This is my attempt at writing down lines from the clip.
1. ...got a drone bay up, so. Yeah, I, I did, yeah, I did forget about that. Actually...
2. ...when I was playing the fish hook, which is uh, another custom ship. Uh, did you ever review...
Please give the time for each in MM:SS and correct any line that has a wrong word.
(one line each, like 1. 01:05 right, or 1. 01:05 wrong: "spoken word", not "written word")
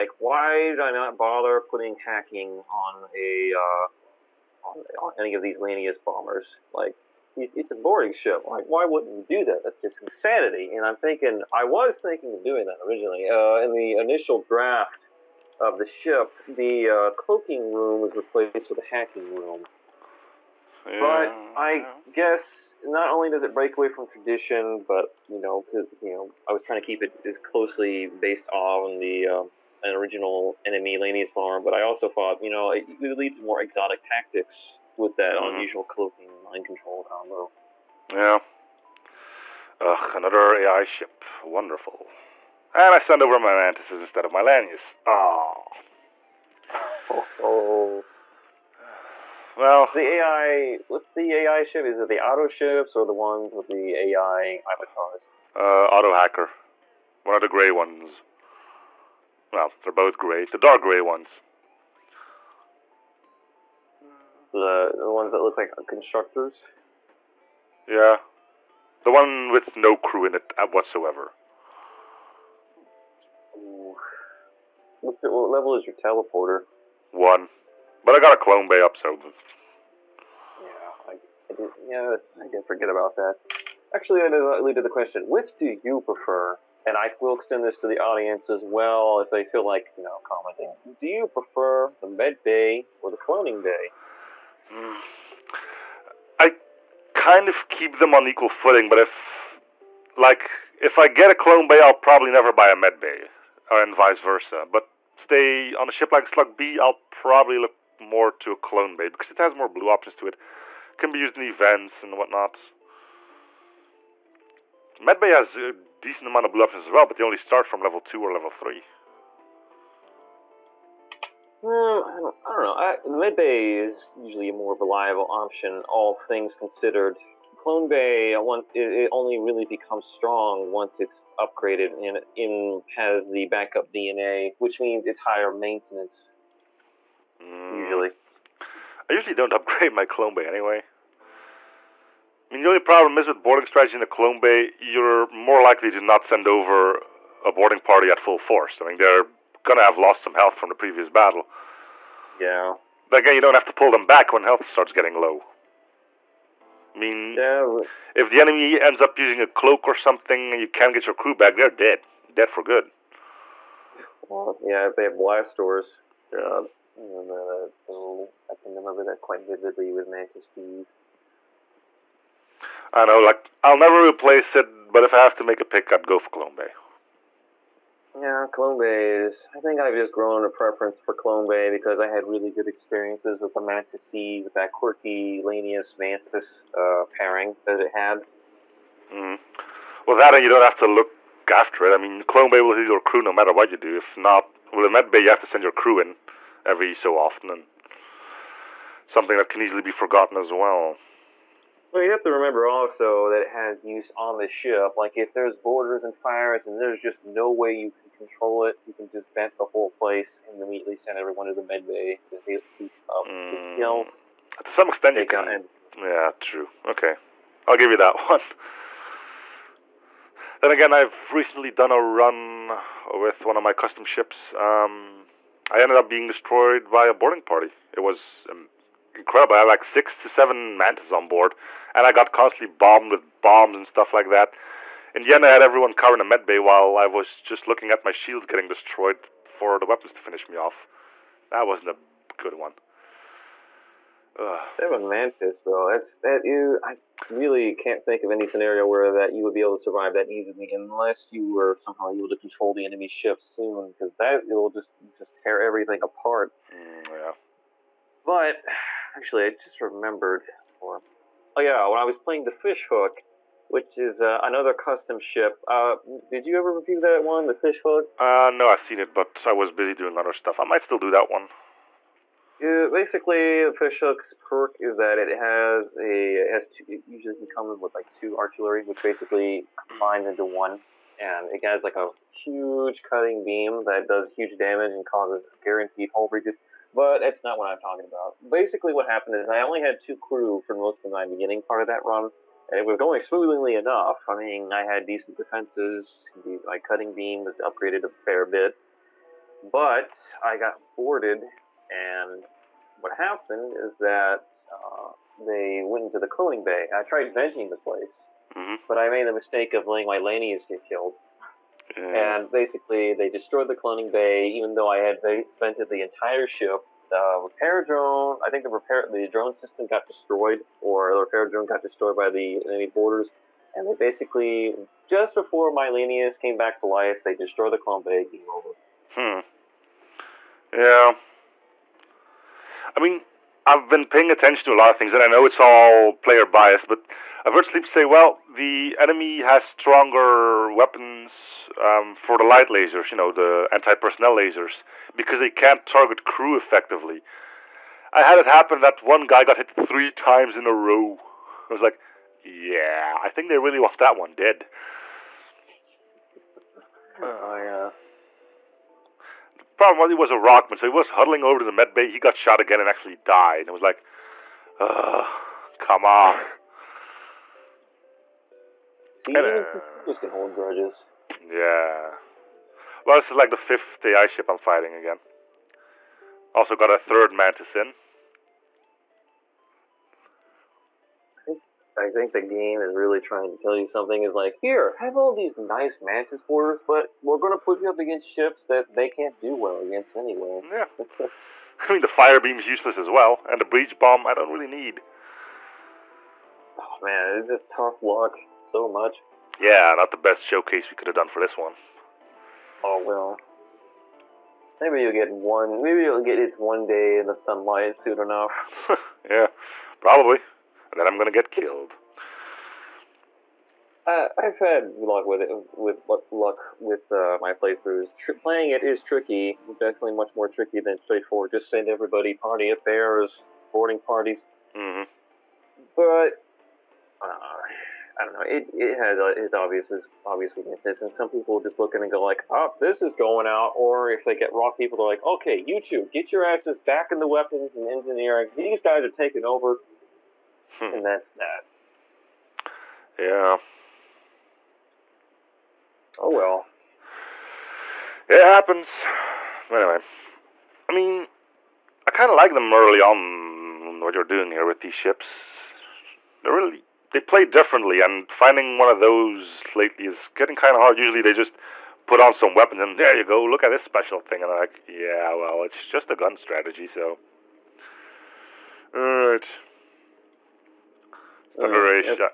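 1. 01:18 wrong: "clone", not "drone"
2. 04:21 right.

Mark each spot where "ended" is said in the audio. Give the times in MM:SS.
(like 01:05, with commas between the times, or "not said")
03:45.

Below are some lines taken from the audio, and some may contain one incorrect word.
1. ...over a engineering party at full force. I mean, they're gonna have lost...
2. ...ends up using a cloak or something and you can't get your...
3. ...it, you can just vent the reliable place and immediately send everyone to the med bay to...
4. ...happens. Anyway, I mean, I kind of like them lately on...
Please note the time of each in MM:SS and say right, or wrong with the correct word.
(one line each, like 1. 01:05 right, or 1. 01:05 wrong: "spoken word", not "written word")
1. 02:26 wrong: "boarding", not "engineering"
2. 02:38 right
3. 03:28 wrong: "whole", not "reliable"
4. 07:28 wrong: "early", not "lately".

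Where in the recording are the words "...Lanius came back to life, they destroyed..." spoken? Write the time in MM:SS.
05:25.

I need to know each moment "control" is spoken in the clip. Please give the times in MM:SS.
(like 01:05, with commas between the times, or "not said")
00:36, 03:28, 04:12.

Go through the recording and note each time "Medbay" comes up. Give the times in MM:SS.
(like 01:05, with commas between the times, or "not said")
01:54, 02:03.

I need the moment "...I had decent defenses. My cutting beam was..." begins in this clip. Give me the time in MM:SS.
04:54.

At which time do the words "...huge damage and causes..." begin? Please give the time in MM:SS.
04:44.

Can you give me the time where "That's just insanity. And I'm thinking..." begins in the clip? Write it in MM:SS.
00:09.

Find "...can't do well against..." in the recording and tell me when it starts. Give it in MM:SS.
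06:29.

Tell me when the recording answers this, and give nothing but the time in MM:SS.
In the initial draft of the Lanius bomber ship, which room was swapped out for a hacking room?
00:17.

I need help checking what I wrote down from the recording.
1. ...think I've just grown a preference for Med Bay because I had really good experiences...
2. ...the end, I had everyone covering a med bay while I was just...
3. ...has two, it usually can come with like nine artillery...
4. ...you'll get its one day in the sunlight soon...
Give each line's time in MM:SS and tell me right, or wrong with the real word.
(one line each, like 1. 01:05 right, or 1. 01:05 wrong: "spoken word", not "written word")
1. 02:59 wrong: "Clone", not "Med"
2. 03:55 right
3. 04:36 wrong: "two", not "nine"
4. 06:46 right.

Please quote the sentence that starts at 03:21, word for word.
Well, you have to remember also that it has use on the ship.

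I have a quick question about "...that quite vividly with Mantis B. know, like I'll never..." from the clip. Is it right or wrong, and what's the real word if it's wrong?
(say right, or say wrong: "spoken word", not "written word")
right.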